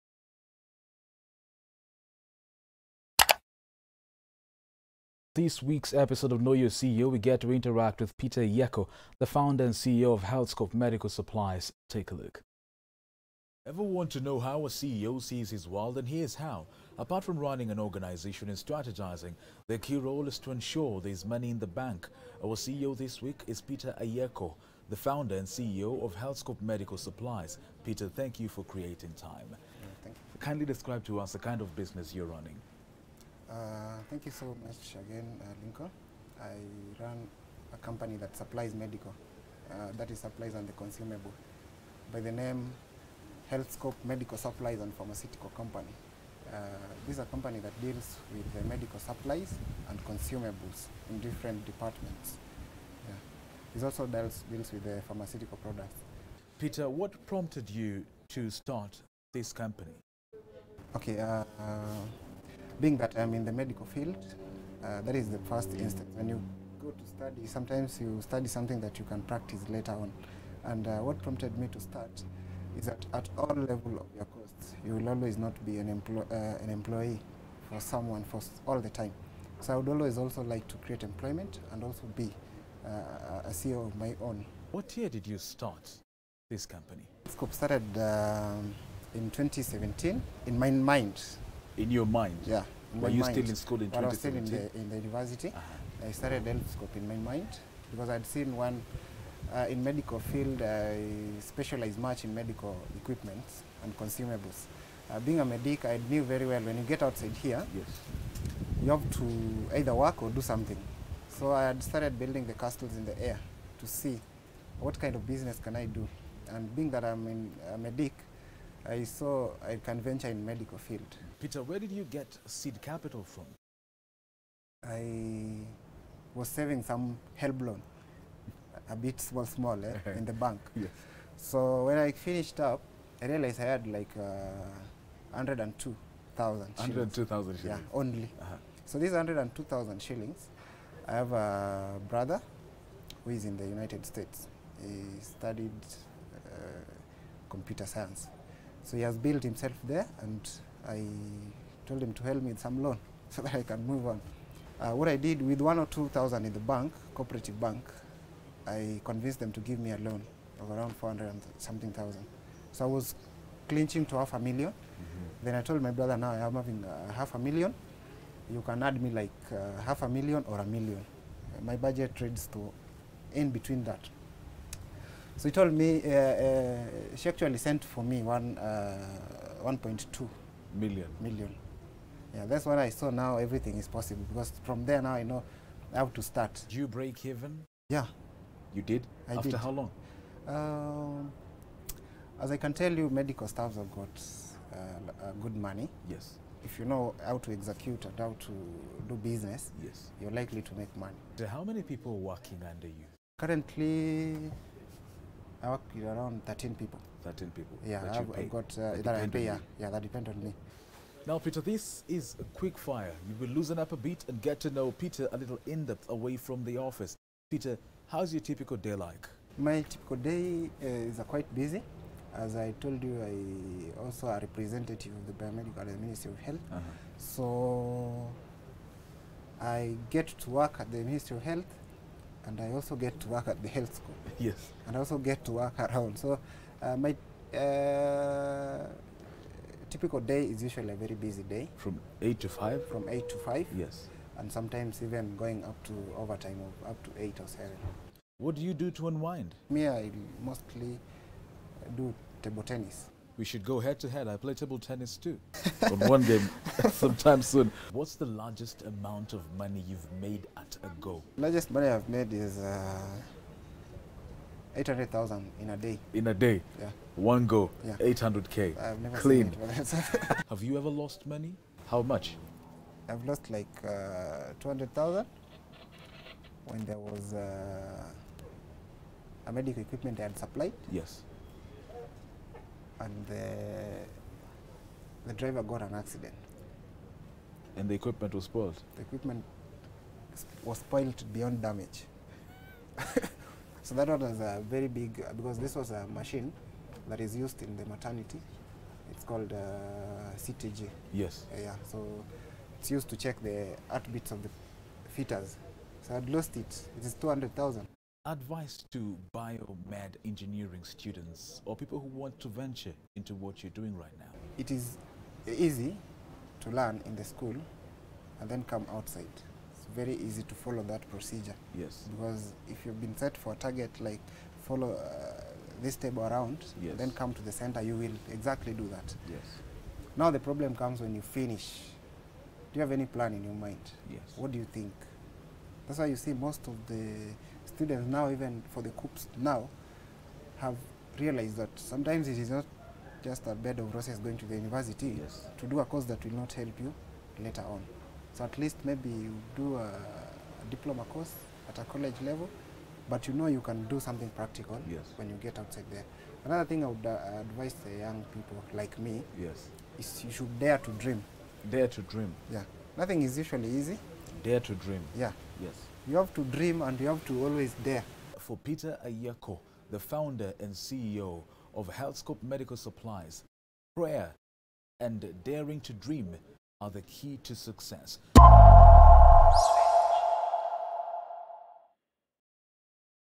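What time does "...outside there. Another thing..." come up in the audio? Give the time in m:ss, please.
5:55.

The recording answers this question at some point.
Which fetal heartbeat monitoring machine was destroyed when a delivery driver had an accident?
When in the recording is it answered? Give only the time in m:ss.
5:00.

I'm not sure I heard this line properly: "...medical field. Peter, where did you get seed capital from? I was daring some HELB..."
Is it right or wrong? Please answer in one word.
wrong.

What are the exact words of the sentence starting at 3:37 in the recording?
Peter, how's your typical day like?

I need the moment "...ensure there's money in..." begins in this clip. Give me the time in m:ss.
0:20.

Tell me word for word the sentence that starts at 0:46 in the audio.
Uh, this is a company that deals with the medical supplies and consumables in different departments.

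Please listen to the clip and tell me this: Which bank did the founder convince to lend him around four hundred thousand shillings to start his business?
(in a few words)
Cooperative Bank.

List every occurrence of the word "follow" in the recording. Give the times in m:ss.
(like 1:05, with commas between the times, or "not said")
5:20, 5:24.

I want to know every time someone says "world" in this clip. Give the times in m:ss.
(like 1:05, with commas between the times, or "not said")
0:15.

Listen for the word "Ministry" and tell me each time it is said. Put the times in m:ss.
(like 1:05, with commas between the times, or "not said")
3:46, 3:51.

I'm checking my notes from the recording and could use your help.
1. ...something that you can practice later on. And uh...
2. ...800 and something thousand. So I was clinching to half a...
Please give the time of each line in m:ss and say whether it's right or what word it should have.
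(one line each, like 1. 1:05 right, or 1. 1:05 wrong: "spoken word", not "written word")
1. 1:08 right
2. 2:40 wrong: "400", not "800".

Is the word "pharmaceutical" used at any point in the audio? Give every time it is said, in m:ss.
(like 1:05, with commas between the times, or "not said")
0:44, 0:55.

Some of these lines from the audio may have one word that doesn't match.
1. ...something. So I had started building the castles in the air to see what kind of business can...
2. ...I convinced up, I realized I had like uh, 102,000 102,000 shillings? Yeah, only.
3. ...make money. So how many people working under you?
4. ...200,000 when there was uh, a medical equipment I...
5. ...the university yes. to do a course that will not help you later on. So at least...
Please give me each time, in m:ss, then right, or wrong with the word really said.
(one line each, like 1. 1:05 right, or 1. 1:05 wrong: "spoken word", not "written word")
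1. 1:50 right
2. 2:11 wrong: "finished", not "convinced"
3. 3:20 right
4. 4:34 right
5. 5:44 right.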